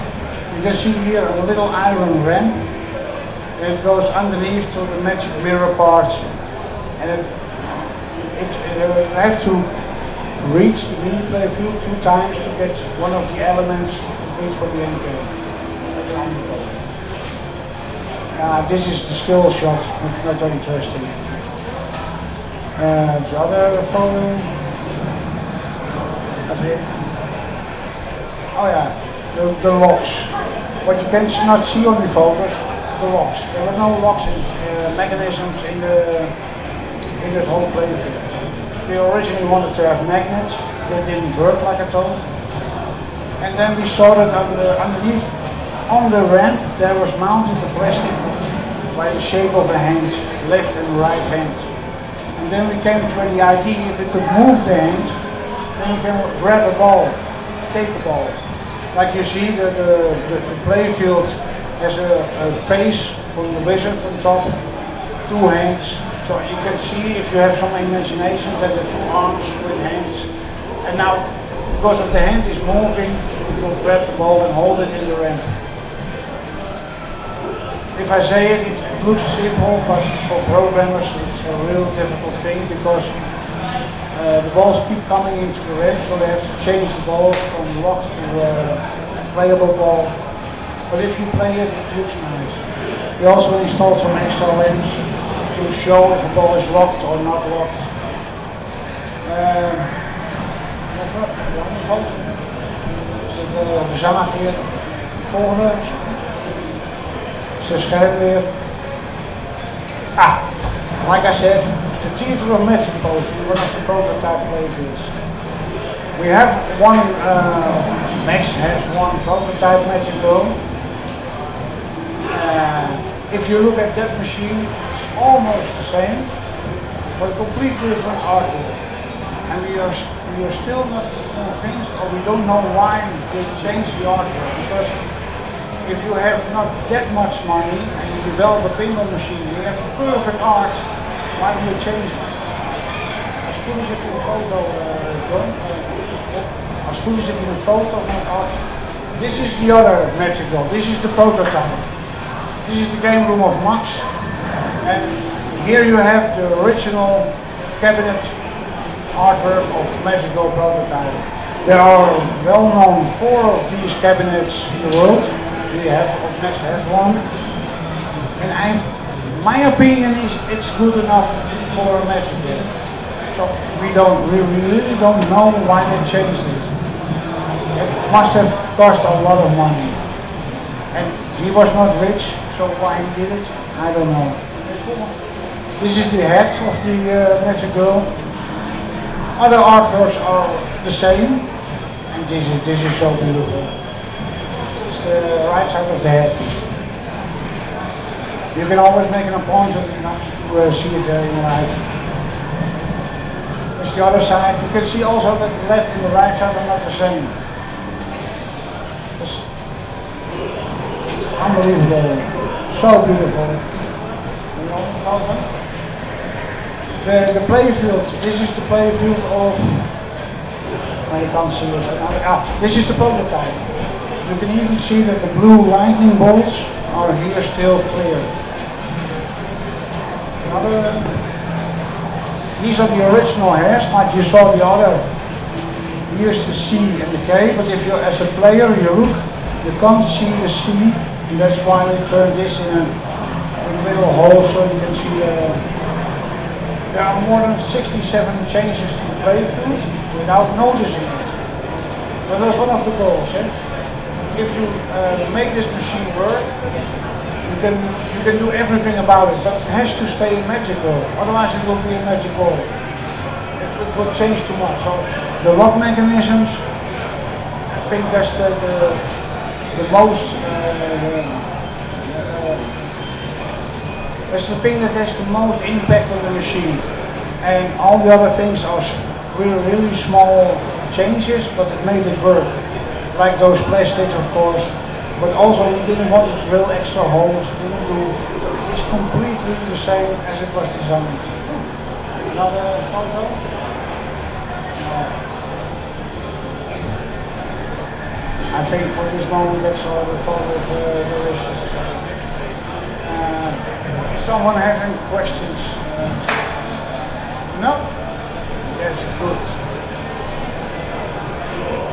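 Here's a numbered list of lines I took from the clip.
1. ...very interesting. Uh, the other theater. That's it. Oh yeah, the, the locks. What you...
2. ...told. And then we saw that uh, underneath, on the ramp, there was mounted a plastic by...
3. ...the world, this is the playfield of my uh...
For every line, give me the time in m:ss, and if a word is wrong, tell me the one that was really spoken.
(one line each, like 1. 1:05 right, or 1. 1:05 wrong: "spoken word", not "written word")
1. 0:20 wrong: "folder", not "theater"
2. 0:41 right
3. 3:37 wrong: "playfield", not "world".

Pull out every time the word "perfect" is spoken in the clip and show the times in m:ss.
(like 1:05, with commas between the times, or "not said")
2:19.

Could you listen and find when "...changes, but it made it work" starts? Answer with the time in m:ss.
4:40.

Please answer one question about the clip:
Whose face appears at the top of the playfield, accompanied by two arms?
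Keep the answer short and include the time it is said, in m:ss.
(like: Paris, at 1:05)
The wizard, at 1:03.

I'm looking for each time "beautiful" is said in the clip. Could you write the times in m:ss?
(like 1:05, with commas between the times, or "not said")
3:13, 3:33.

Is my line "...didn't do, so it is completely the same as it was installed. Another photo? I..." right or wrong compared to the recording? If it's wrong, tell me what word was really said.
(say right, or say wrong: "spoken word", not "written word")
wrong: "designed", not "installed".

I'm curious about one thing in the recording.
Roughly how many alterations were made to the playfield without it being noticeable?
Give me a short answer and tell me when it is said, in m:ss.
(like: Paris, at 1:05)
More than 67, at 4:07.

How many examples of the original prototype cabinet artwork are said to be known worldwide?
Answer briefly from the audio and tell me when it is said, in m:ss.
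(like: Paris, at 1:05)
4, at 2:43.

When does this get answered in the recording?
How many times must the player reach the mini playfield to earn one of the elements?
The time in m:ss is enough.
0:11.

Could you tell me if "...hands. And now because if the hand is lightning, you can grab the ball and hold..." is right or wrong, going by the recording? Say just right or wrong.
wrong.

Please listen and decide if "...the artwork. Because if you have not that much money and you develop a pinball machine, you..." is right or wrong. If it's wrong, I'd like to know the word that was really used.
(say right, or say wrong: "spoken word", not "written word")
right.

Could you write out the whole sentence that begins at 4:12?
But that's one of the goals.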